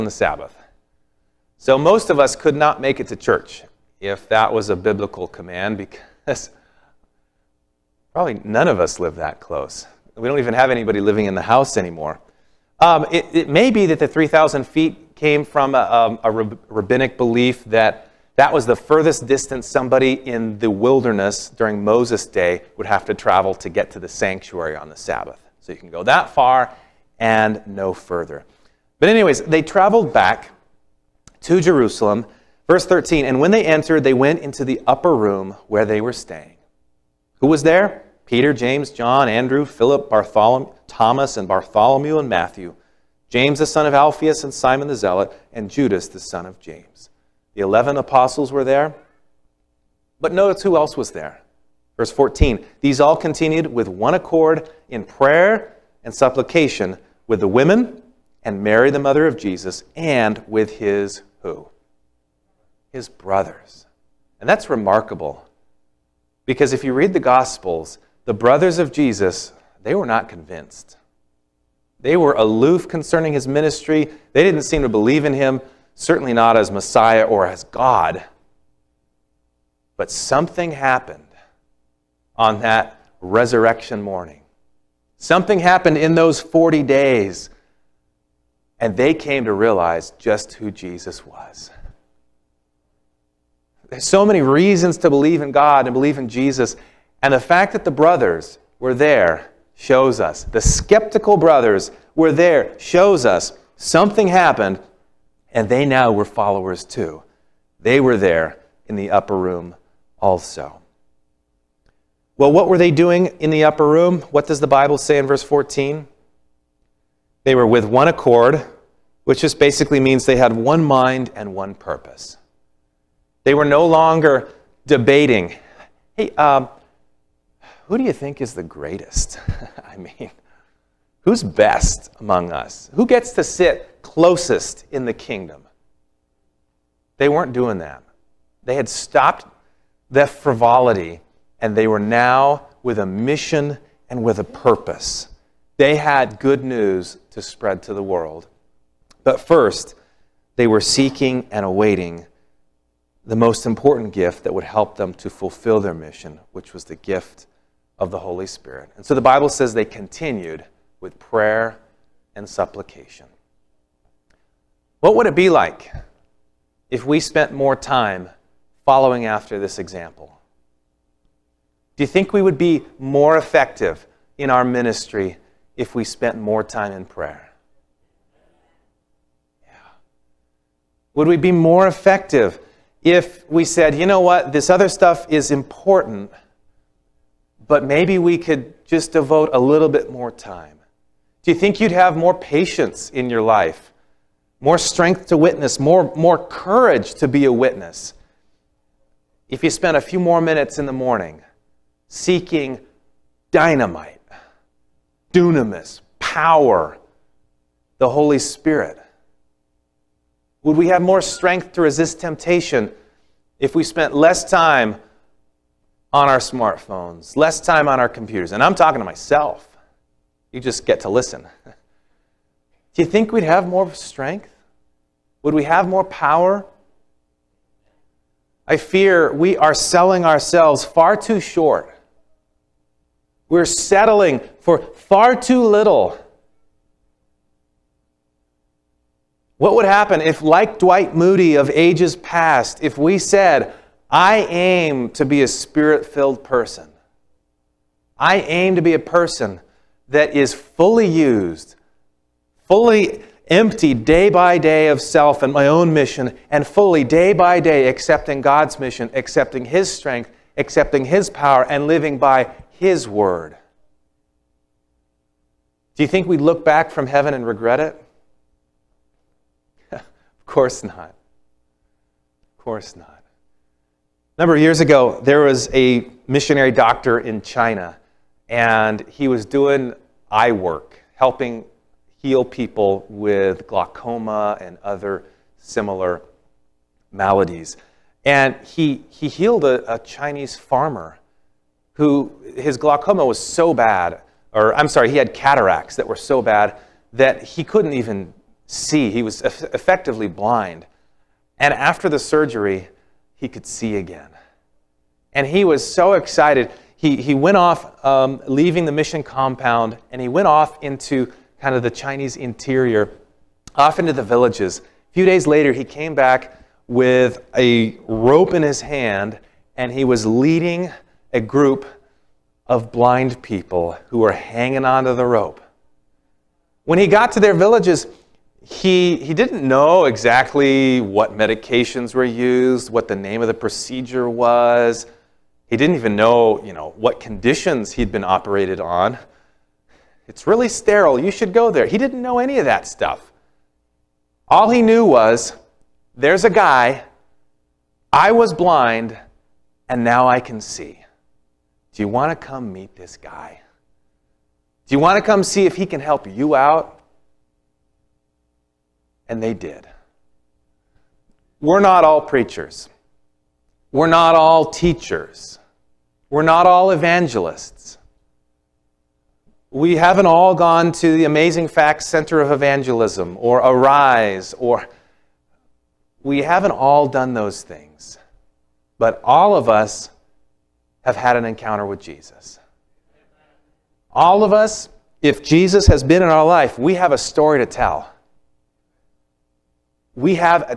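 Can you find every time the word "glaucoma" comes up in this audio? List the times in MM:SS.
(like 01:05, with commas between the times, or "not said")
04:43, 04:52.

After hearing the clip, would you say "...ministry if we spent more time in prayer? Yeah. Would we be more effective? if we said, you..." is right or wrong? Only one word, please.
right.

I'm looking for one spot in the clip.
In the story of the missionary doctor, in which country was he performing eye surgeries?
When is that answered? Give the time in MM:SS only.
04:37.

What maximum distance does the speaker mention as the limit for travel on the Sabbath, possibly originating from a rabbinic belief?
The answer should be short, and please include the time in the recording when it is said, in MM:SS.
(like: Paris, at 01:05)
3,000 feet, at 00:14.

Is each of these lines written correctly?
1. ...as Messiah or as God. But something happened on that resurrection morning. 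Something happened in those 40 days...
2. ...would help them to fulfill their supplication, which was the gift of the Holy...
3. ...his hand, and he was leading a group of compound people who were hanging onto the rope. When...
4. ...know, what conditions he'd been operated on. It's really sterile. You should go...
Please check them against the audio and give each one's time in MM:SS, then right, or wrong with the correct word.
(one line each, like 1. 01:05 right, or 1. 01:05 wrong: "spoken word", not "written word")
1. 01:16 right
2. 02:34 wrong: "mission", not "supplication"
3. 05:18 wrong: "blind", not "compound"
4. 05:36 right.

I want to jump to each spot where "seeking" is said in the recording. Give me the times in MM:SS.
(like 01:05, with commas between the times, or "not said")
02:30, 03:22.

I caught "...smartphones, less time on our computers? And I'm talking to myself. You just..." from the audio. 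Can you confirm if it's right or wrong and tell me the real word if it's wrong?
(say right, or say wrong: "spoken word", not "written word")
right.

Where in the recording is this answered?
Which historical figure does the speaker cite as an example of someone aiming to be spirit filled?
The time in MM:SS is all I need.
04:00.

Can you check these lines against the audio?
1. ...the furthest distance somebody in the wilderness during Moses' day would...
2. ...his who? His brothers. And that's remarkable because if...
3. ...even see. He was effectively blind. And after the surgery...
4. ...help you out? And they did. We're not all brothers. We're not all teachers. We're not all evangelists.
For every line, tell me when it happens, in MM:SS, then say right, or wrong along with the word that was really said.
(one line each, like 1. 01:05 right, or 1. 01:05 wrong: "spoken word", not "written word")
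1. 00:18 right
2. 01:00 right
3. 04:57 right
4. 05:55 wrong: "preachers", not "brothers".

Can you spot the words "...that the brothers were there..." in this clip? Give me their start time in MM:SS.
01:37.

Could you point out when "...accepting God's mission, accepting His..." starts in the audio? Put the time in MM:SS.
04:17.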